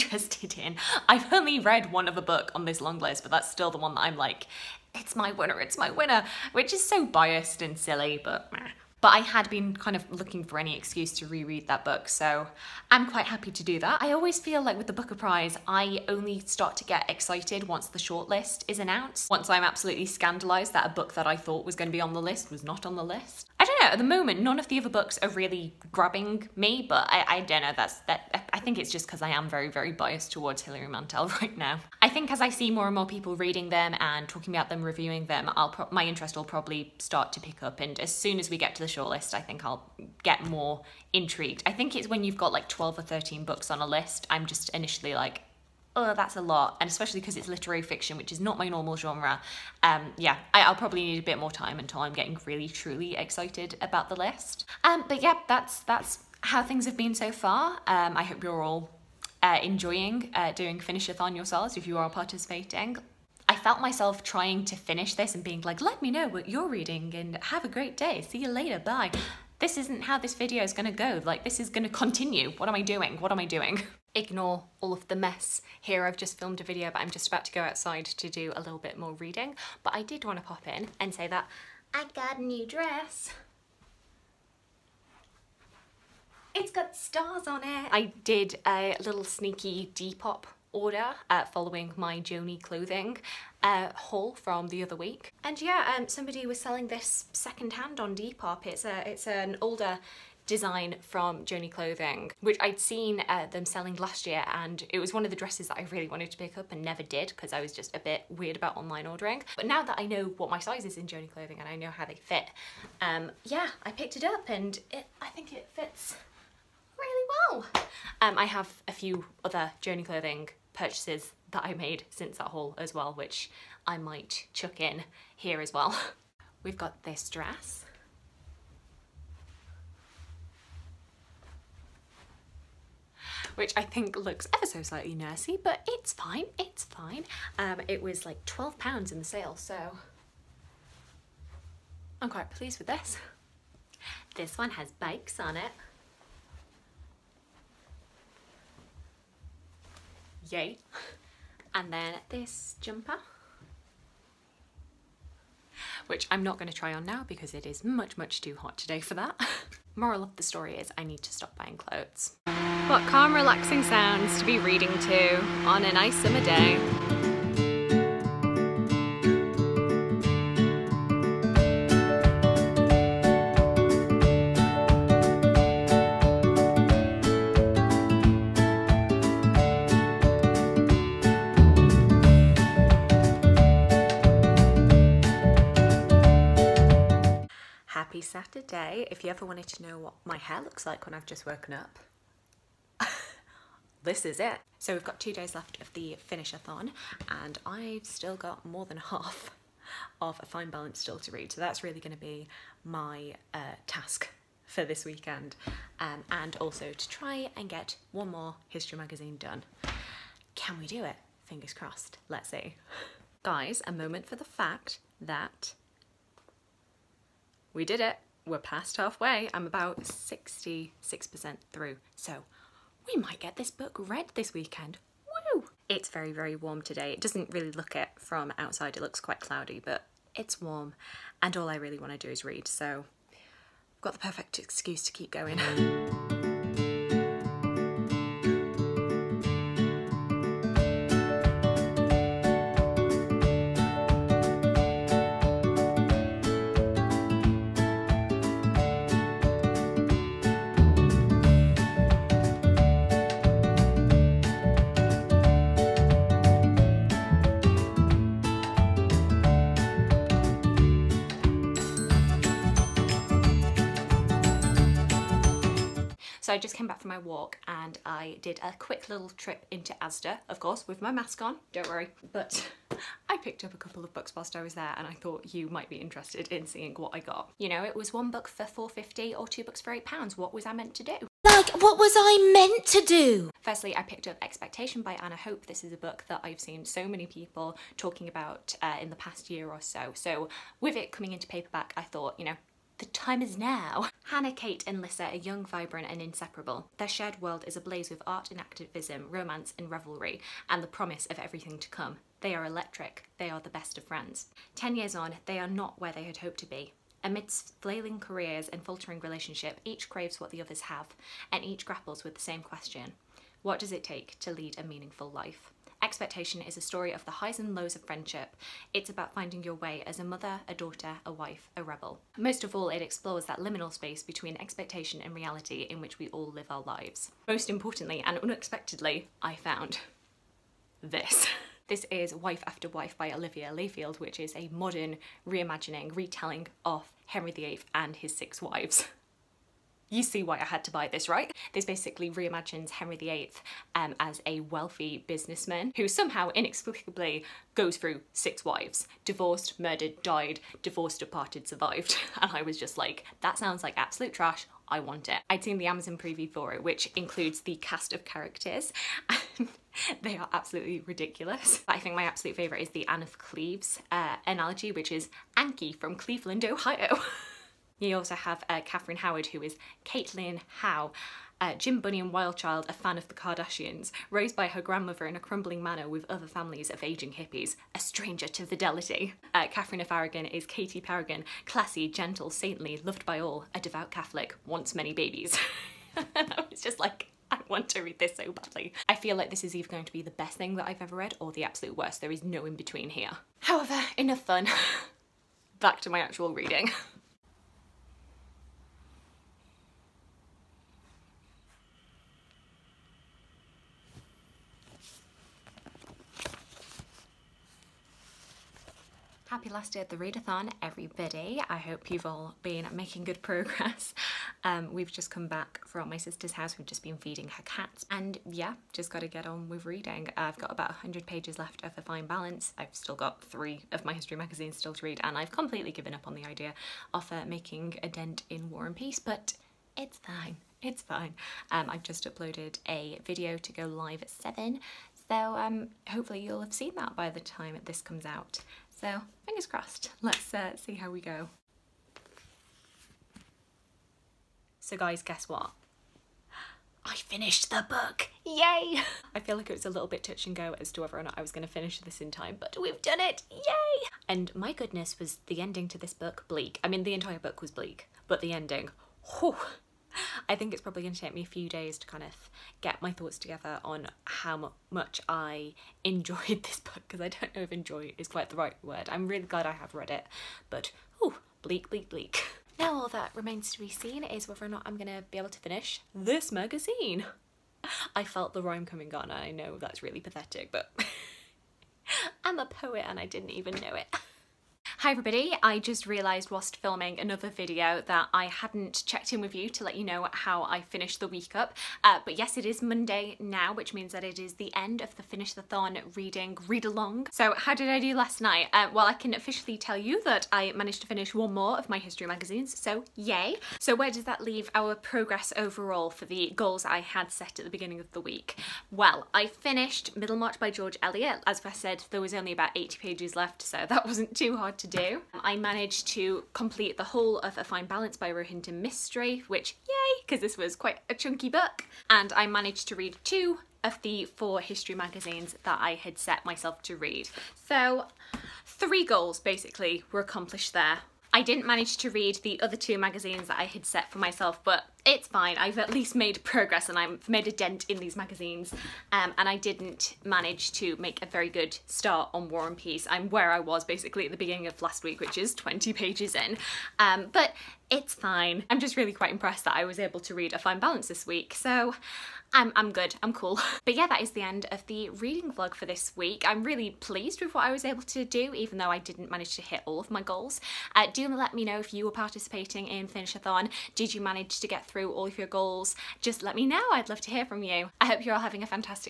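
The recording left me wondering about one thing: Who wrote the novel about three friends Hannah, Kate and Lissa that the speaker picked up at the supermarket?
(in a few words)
Anna Hope.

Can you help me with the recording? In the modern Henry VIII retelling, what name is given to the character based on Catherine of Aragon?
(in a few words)
Katie Paragon.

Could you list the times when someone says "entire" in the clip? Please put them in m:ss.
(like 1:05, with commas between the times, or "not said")
7:37.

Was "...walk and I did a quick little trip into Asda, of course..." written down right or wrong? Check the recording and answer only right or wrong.
right.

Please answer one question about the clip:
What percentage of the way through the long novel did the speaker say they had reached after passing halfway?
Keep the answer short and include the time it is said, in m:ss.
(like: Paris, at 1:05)
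66%, at 3:40.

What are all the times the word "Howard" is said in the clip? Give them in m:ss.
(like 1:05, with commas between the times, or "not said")
6:09.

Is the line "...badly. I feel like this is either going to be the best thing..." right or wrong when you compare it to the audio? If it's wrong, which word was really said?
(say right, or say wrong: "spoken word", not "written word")
right.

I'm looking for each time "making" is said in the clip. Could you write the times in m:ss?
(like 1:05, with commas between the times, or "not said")
6:52, 7:07.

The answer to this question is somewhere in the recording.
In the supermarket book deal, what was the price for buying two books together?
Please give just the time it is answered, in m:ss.
4:39.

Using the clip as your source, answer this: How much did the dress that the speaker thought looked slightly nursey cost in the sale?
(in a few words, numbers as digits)
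£12.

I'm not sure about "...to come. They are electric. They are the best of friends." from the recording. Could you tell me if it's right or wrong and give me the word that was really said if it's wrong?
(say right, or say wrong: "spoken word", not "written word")
right.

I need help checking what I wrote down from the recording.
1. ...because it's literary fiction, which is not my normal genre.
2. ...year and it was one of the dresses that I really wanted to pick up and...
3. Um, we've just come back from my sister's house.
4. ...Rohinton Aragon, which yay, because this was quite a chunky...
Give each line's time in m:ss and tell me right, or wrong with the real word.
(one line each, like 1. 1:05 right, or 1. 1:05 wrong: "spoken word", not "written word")
1. 0:47 right
2. 1:44 right
3. 6:54 right
4. 8:38 wrong: "Mistry", not "Aragon".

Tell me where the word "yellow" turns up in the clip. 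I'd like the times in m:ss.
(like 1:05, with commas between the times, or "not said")
not said.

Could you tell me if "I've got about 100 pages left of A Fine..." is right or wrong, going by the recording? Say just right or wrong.
right.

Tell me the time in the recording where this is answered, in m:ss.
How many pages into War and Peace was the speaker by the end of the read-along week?
9:05.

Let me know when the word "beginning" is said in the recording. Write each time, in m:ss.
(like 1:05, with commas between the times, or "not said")
8:27, 9:04.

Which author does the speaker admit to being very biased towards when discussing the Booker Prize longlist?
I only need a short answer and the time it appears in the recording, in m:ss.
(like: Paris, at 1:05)
Hilary Mantel, at 0:30.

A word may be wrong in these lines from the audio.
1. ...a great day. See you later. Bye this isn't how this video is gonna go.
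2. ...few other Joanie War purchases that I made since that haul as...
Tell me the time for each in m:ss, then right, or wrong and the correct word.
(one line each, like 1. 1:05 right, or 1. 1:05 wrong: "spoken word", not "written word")
1. 1:07 right
2. 1:58 wrong: "Clothing", not "War".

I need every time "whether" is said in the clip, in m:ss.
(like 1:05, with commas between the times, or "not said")
7:31, 7:54.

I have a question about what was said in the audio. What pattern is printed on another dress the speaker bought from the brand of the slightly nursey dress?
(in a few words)
Bikes.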